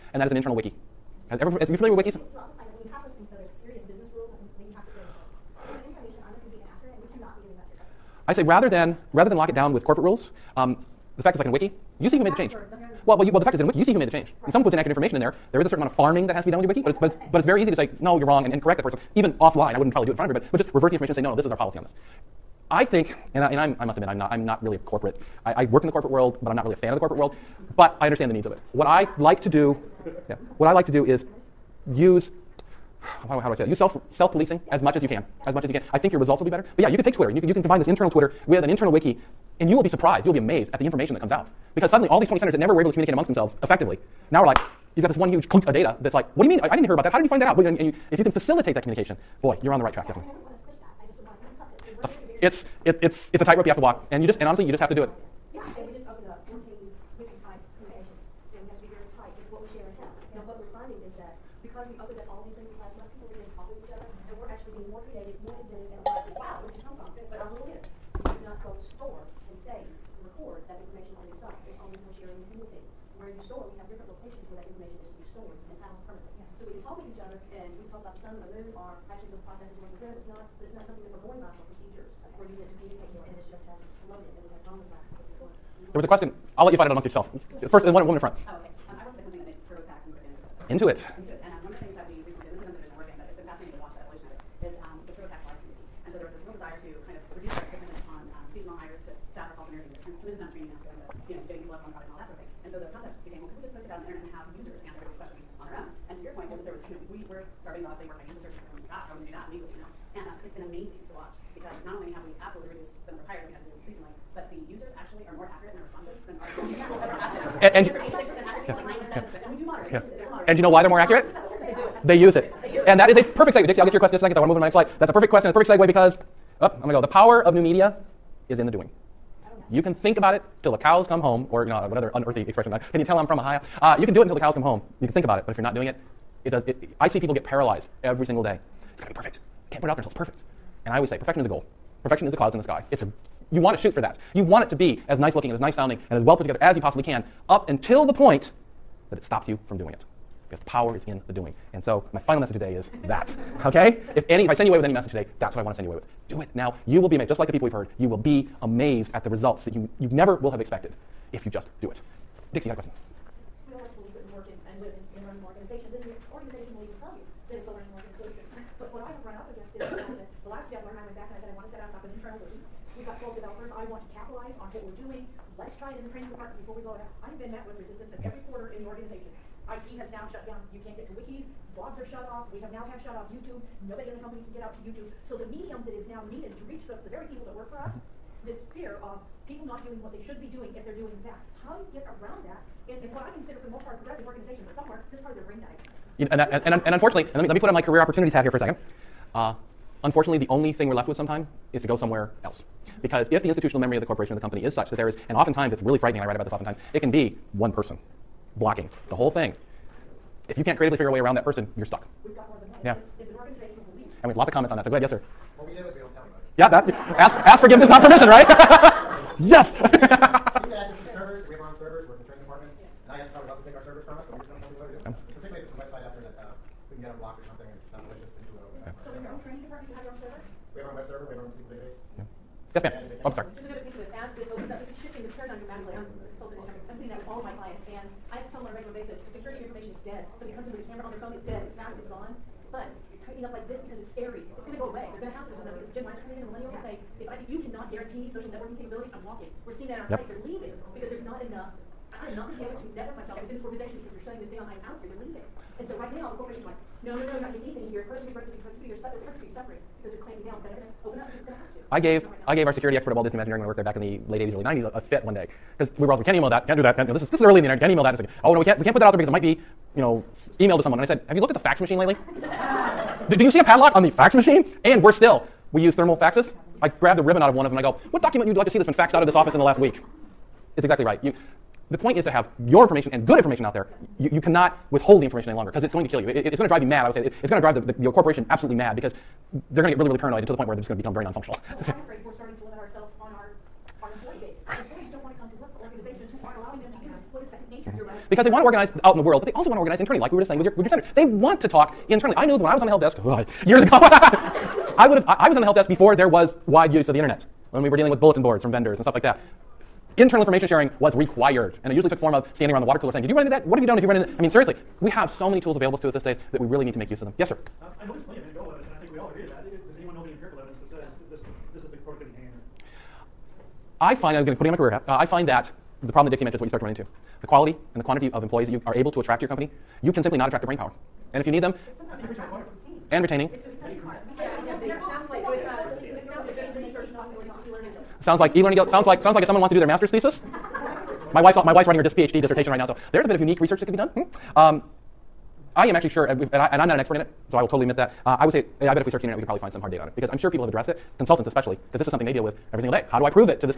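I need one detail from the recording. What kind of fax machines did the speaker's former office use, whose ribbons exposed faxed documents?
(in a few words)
thermal faxes.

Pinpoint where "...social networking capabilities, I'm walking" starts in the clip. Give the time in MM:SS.
04:08.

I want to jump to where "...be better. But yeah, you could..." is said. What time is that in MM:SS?
00:36.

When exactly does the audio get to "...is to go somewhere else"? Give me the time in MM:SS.
03:21.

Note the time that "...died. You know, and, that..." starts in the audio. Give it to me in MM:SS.
03:15.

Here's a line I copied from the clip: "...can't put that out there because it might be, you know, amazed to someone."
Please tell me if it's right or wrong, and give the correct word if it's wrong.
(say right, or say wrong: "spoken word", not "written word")
wrong: "emailed", not "amazed".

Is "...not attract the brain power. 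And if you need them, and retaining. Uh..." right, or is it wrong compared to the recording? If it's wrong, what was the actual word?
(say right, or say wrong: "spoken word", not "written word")
right.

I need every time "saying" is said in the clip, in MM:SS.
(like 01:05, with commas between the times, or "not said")
05:00, 05:13.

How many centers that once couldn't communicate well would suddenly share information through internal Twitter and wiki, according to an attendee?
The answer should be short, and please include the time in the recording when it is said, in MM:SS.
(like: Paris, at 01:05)
20, at 00:42.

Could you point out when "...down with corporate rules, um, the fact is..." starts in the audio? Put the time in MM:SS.
00:09.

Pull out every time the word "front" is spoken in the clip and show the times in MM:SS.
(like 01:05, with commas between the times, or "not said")
00:20, 01:28.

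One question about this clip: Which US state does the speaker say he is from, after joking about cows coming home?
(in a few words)
Ohio.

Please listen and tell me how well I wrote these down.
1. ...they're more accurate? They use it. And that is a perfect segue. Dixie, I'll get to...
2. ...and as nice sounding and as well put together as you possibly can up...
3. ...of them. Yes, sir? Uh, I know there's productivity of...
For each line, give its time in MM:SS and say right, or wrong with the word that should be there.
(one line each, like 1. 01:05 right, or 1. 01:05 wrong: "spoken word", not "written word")
1. 02:00 right
2. 02:25 right
3. 05:17 wrong: "plenty", not "productivity".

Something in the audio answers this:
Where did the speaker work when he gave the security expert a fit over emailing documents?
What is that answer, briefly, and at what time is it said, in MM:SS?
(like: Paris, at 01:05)
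Walt Disney Imagineering, at 04:23.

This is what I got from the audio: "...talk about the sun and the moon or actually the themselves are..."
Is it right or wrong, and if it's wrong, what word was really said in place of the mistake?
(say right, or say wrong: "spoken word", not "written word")
wrong: "processes", not "themselves".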